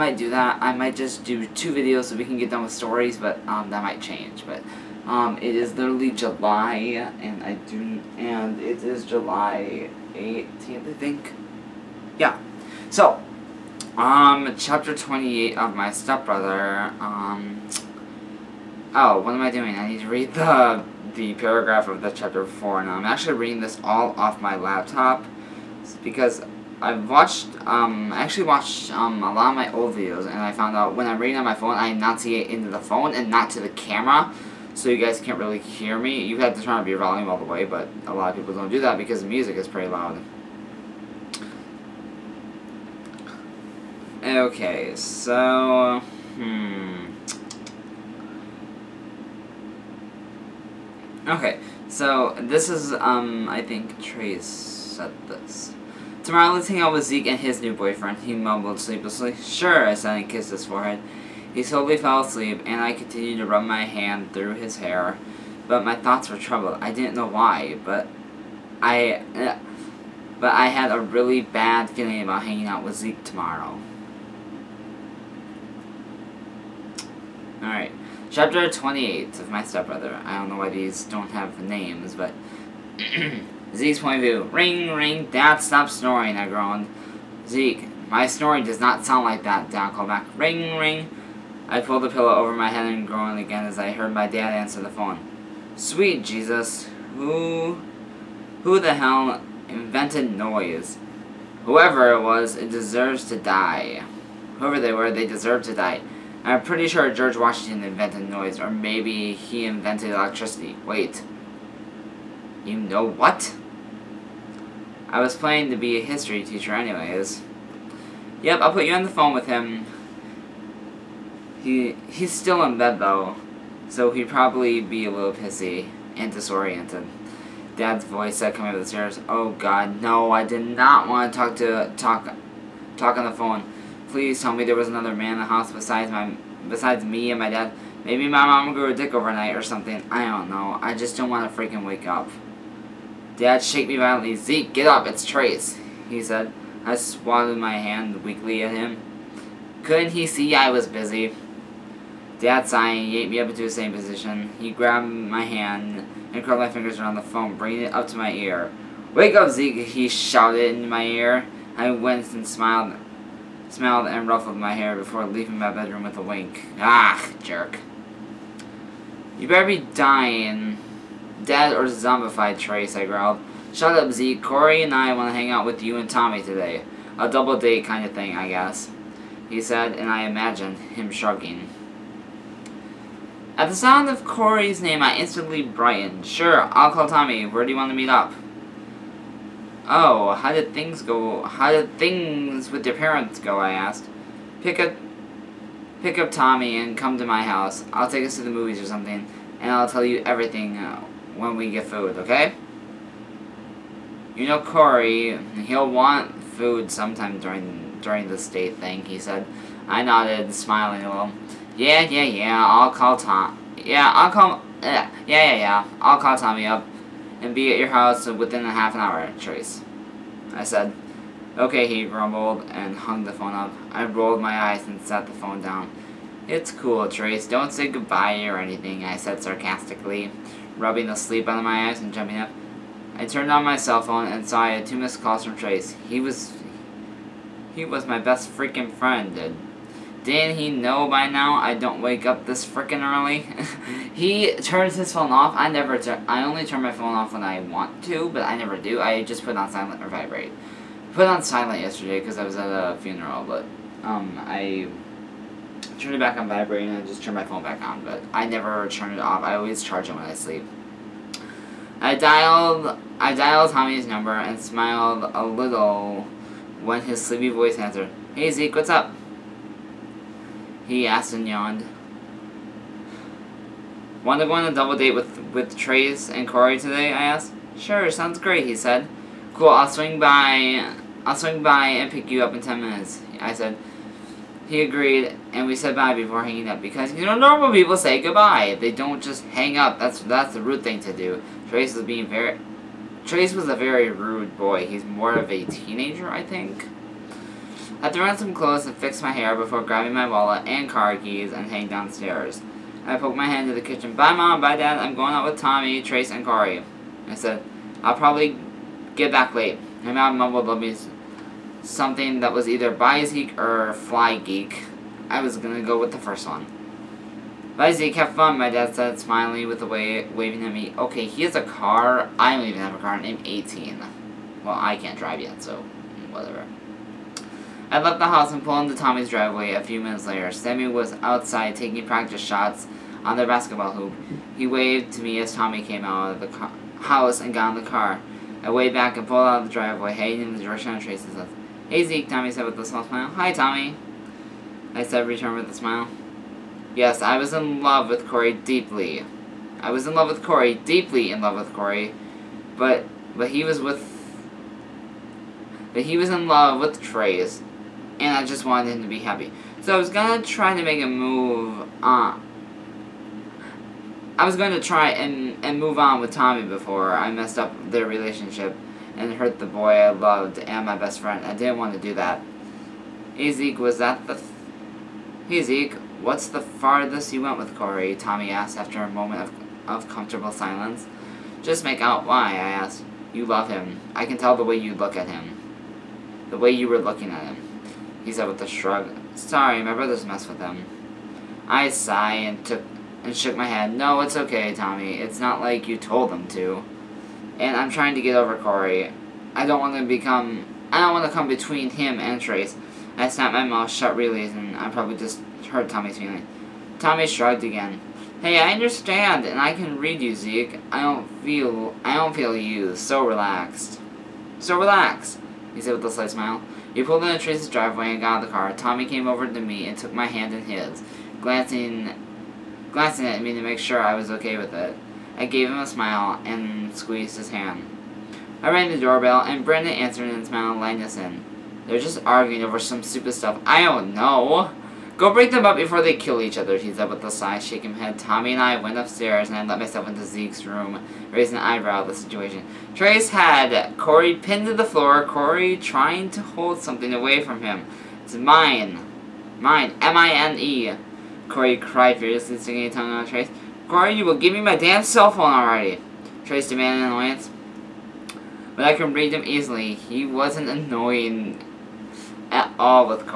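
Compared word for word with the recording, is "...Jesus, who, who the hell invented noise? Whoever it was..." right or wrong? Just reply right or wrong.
right.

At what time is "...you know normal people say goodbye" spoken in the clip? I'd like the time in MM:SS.
04:47.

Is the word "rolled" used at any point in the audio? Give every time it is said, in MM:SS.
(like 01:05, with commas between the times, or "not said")
03:44.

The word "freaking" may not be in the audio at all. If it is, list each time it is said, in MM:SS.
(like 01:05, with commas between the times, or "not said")
02:21, 03:58, 04:02.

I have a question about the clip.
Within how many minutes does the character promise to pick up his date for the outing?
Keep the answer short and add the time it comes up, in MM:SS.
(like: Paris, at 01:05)
10, at 04:42.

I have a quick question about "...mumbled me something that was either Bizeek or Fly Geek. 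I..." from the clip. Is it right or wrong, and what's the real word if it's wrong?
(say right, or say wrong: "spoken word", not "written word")
right.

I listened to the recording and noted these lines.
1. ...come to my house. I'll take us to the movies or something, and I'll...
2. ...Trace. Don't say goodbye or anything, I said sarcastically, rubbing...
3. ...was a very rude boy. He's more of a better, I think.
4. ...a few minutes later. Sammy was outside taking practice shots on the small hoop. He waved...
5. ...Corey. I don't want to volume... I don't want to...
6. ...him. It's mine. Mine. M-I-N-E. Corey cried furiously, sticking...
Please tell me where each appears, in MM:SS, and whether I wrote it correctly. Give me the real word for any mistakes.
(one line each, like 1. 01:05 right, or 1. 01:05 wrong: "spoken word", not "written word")
1. 03:16 right
2. 03:47 right
3. 04:53 wrong: "teenager", not "better"
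4. 05:29 wrong: "basketball", not "small"
5. 06:38 wrong: "become", not "volume"
6. 07:27 right.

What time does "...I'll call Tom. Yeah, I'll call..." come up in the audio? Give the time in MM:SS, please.
03:32.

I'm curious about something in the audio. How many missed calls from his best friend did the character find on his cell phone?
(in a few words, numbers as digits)
2.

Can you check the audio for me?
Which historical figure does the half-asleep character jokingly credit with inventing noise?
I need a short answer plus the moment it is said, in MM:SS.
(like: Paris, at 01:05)
George Washington, at 01:47.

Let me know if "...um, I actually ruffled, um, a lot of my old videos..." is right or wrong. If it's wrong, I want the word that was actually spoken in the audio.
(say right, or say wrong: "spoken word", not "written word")
wrong: "watched", not "ruffled".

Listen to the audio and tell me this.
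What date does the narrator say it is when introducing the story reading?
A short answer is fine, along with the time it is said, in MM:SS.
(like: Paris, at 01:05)
July 18th, at 00:09.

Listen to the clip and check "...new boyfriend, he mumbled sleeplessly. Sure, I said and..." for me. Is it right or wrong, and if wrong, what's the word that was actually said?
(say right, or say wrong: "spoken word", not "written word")
right.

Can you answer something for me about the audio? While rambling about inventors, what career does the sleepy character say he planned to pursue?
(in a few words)
History teacher.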